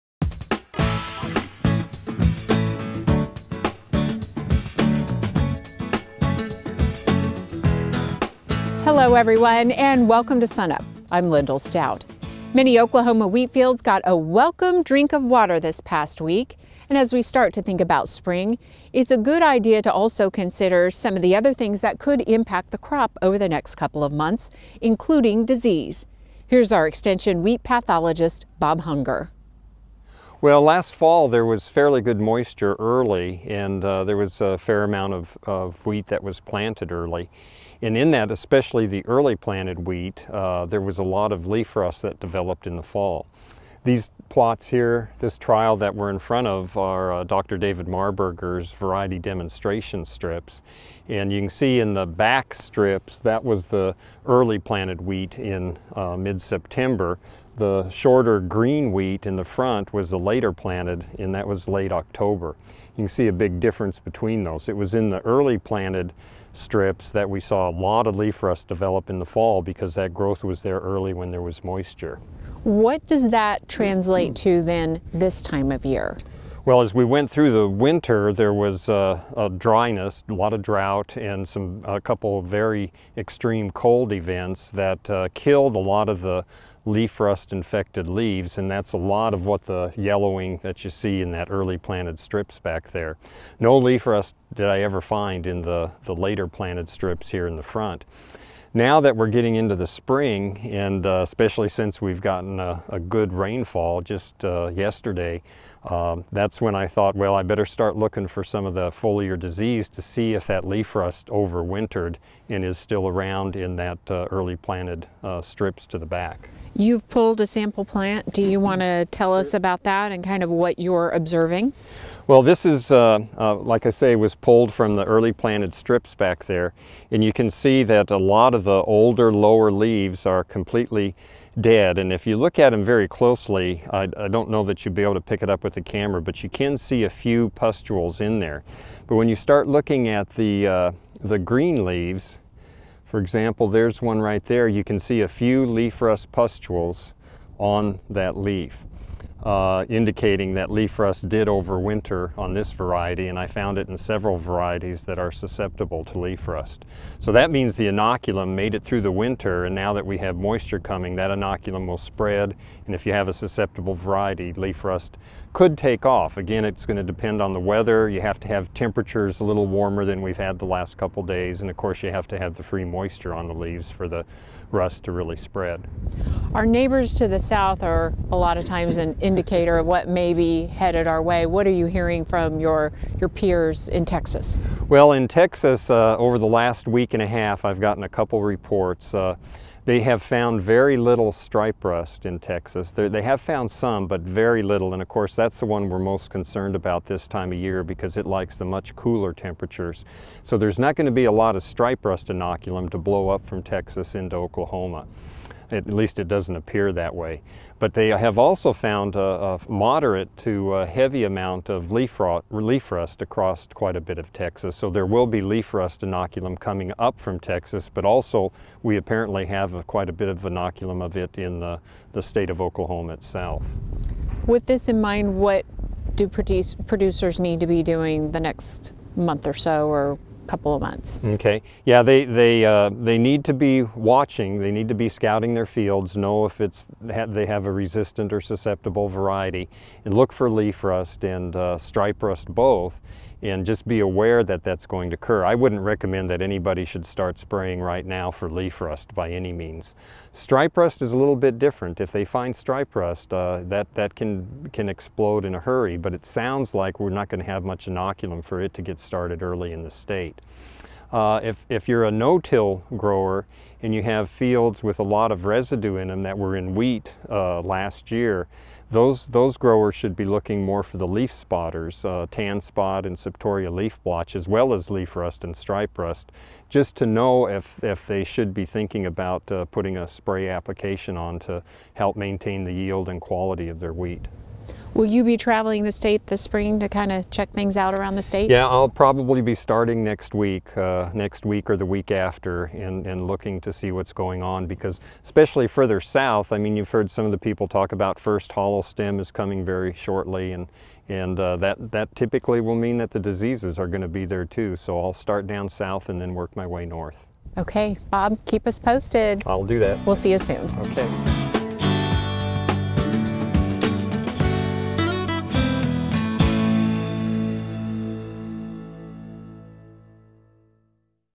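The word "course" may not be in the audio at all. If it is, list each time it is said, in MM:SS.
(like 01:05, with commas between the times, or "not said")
02:51, 03:15.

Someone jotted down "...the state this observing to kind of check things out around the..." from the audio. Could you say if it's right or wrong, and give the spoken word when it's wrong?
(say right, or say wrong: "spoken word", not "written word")
wrong: "spring", not "observing".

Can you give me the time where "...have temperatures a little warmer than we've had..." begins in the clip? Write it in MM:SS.
02:48.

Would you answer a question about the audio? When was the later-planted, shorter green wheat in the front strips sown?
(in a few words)
Late October.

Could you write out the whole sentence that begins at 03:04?
Well, in Texas, uh, over the last week and a half, I've gotten a couple reports.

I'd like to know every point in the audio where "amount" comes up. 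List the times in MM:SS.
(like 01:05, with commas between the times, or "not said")
00:34, 03:31.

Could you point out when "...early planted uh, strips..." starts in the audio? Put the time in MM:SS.
01:54.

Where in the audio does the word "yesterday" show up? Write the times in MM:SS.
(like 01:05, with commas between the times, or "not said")
01:44.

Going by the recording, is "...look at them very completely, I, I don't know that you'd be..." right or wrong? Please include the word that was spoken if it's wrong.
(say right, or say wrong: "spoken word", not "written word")
wrong: "closely", not "completely".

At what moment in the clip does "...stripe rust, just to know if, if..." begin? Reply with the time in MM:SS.
04:35.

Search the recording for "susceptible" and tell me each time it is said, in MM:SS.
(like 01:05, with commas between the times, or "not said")
02:35, 02:43, 03:58.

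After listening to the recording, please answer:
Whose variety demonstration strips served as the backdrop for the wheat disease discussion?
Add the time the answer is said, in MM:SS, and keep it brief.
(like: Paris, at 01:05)
David Marburger, at 00:47.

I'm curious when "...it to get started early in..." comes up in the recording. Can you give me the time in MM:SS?
04:18.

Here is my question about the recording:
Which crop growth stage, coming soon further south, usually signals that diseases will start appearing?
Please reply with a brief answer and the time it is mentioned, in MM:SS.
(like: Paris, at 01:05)
First hollow stem, at 04:58.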